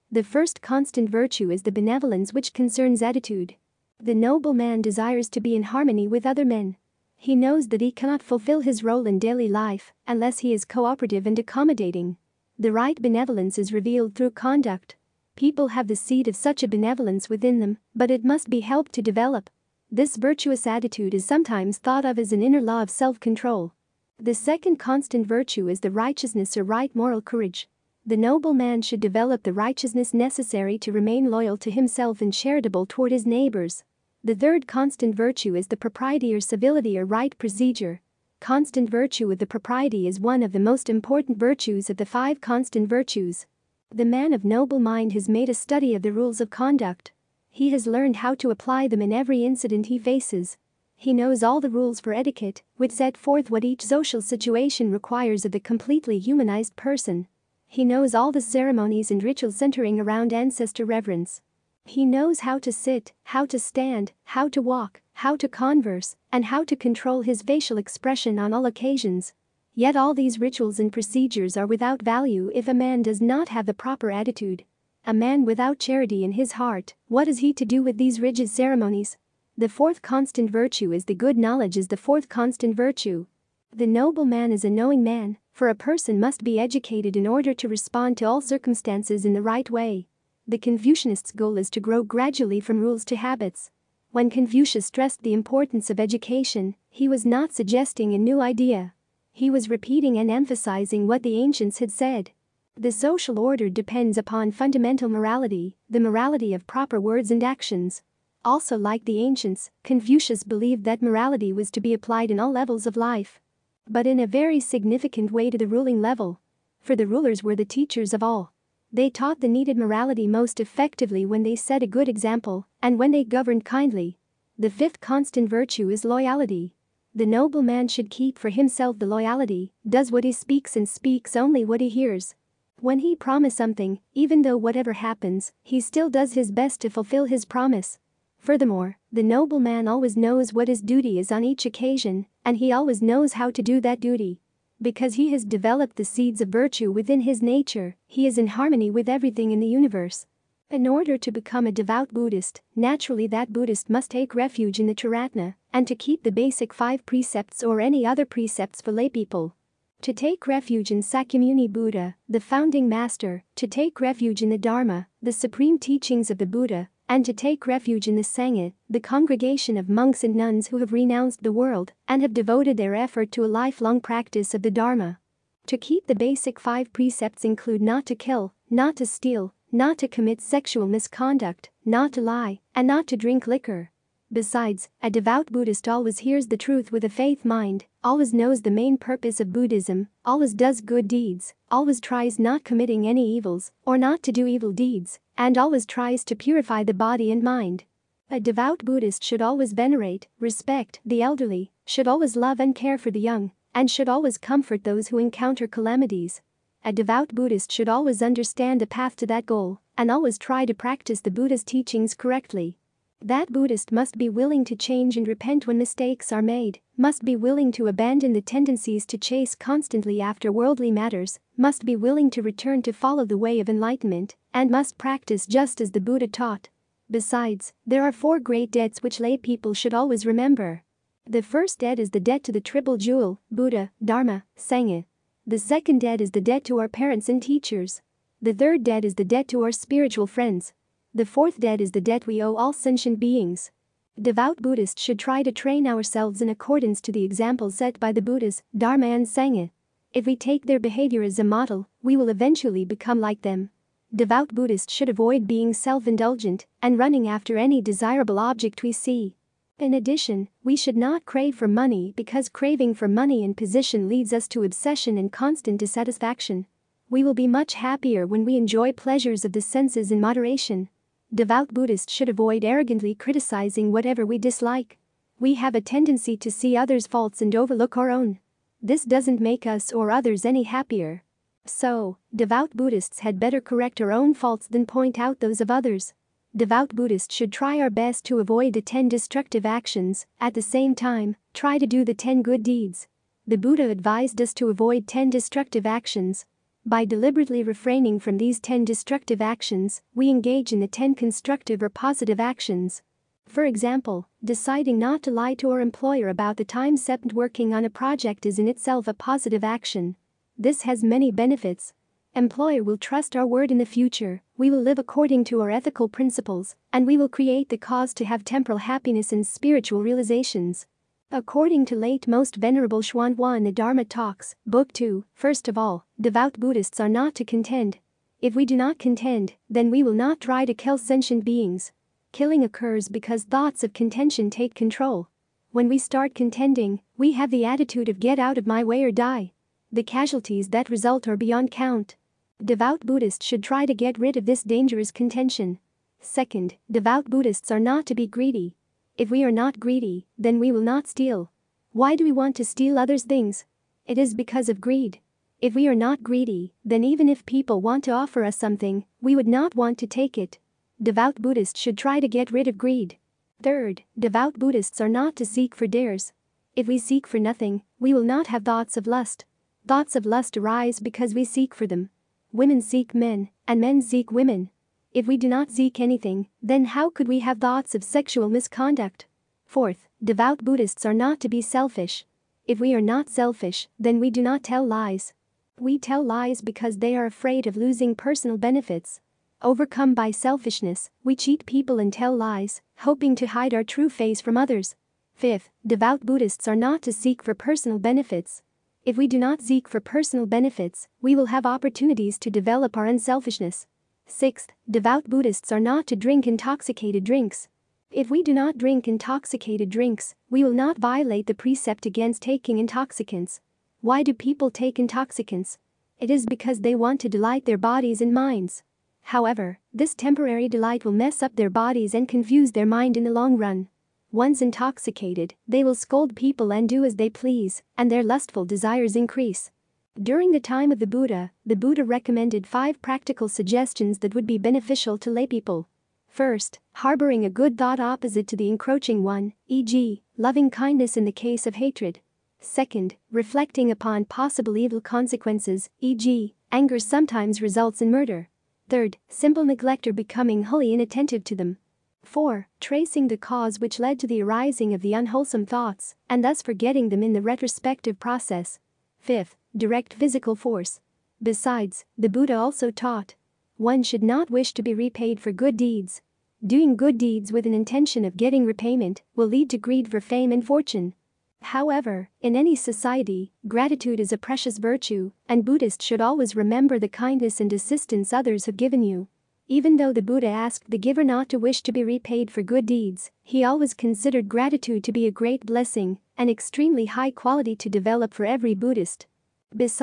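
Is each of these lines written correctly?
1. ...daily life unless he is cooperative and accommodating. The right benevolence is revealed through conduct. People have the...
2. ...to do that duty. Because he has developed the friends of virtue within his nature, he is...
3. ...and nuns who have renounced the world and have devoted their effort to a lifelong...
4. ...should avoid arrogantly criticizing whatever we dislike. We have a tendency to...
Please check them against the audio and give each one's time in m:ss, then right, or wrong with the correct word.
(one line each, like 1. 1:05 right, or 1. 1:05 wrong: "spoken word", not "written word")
1. 0:09 right
2. 2:23 wrong: "seeds", not "friends"
3. 2:50 right
4. 4:32 right.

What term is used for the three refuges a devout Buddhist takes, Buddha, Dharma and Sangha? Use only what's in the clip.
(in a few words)
Triratna.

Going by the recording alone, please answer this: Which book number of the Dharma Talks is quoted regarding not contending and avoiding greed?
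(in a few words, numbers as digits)
2.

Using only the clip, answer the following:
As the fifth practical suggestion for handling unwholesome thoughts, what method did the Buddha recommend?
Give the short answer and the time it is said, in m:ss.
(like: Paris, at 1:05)
Direct physical force, at 7:39.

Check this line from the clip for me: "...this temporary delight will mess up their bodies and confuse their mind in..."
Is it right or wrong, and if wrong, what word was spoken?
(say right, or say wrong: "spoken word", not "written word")
right.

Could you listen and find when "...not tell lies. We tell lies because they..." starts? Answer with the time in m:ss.
6:24.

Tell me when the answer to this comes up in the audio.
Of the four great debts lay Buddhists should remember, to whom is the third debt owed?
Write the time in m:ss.
3:59.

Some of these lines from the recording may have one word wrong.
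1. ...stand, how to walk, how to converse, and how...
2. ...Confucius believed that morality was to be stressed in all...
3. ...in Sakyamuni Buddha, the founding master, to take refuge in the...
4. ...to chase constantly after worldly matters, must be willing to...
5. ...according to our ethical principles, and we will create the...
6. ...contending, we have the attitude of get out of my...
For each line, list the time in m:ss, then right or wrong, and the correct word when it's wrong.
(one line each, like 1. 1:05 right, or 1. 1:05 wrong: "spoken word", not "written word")
1. 1:03 right
2. 1:49 wrong: "applied", not "stressed"
3. 2:40 right
4. 3:39 right
5. 5:14 right
6. 5:36 right.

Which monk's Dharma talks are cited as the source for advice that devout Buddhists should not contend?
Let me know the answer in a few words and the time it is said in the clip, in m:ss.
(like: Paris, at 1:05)
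Xuanhua, at 5:23.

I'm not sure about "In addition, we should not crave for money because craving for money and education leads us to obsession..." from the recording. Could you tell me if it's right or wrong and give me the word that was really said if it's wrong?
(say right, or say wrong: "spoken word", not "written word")
wrong: "position", not "education".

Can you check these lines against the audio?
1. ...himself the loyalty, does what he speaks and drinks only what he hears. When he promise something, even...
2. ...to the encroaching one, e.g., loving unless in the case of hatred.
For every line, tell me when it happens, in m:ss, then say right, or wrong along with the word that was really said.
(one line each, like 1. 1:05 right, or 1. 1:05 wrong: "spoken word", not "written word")
1. 2:08 wrong: "speaks", not "drinks"
2. 7:18 wrong: "kindness", not "unless".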